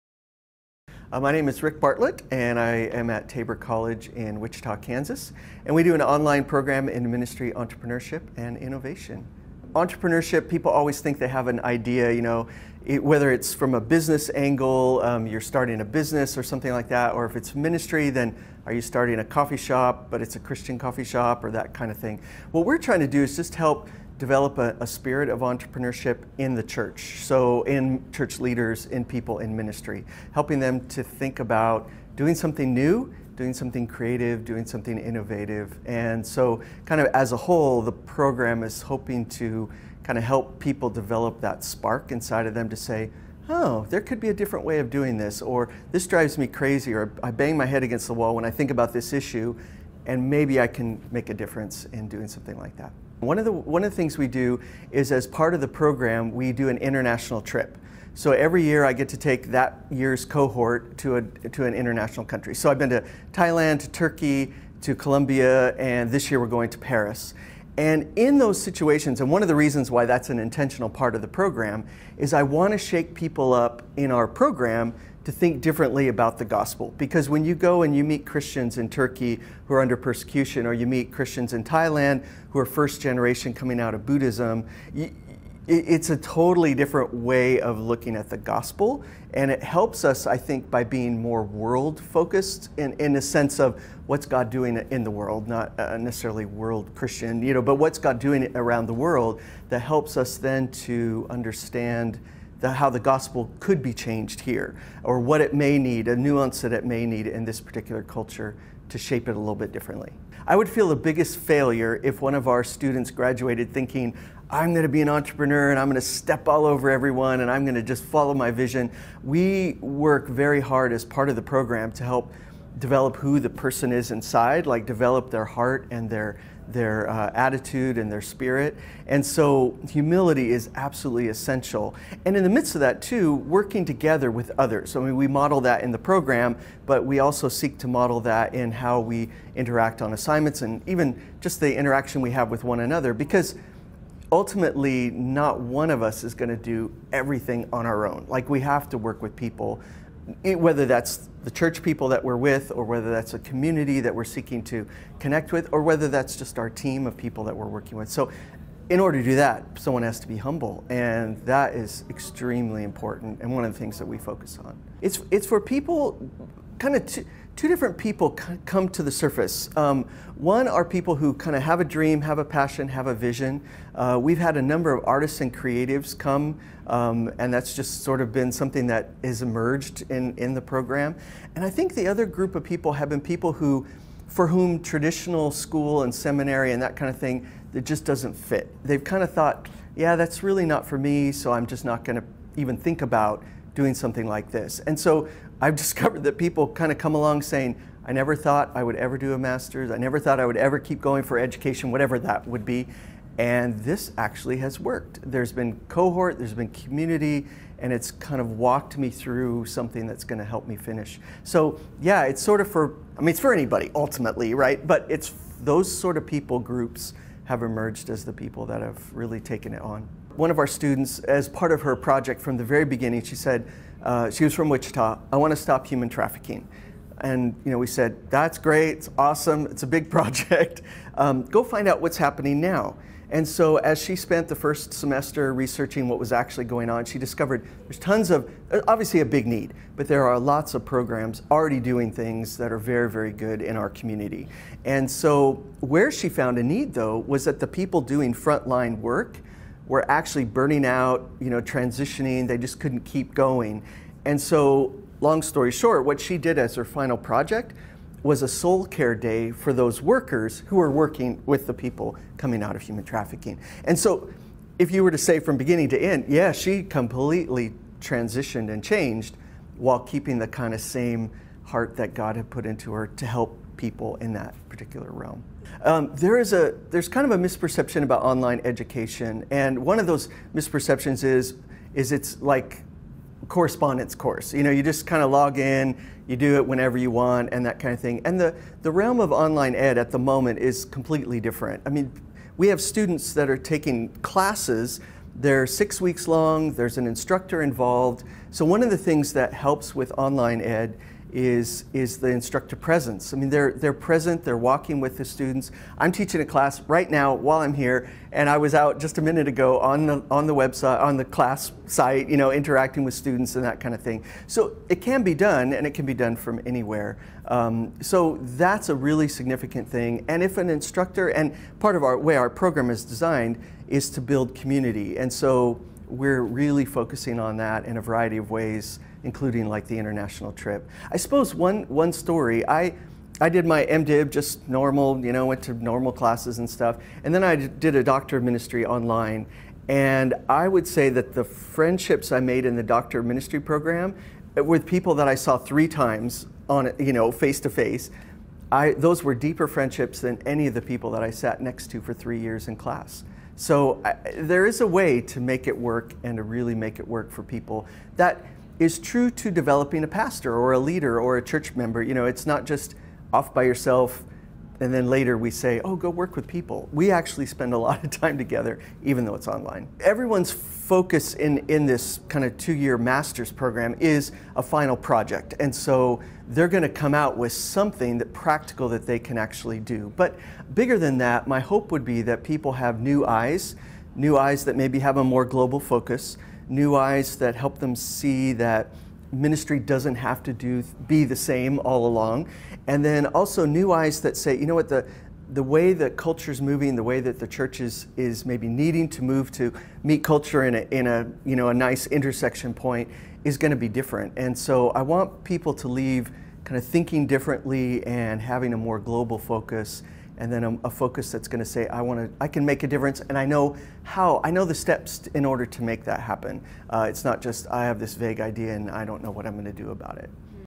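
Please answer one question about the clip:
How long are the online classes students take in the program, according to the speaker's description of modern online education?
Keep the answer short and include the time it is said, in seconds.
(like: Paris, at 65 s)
6 weeks, at 295 s.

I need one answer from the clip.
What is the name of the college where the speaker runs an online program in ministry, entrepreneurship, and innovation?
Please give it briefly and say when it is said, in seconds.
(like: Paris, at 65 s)
Tabor College, at 3 s.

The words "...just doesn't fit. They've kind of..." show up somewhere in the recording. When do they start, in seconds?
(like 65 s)
187 s.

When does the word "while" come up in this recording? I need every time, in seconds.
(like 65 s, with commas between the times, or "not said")
269 s, 307 s.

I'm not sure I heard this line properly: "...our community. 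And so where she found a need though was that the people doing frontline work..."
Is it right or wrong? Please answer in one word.
right.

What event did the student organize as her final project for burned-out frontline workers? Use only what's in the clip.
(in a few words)
A soul care day.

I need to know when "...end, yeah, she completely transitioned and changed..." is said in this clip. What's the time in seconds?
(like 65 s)
266 s.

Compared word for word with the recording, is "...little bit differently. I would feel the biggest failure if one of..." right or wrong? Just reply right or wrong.
right.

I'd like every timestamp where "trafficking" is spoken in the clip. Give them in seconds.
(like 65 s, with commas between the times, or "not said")
226 s, 263 s.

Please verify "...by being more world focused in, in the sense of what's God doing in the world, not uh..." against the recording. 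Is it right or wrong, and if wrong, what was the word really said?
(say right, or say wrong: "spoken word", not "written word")
right.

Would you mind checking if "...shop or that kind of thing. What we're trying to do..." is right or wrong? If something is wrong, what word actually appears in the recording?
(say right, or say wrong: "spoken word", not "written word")
right.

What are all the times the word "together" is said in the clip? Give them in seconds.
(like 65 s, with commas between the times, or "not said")
133 s, 368 s.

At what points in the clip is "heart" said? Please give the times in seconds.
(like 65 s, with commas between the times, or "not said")
125 s, 271 s.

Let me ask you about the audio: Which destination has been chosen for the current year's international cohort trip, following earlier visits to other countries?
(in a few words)
Paris.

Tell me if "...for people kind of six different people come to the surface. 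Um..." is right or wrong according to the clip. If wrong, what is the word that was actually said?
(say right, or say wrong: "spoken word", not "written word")
wrong: "two", not "six".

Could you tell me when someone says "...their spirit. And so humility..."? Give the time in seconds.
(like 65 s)
128 s.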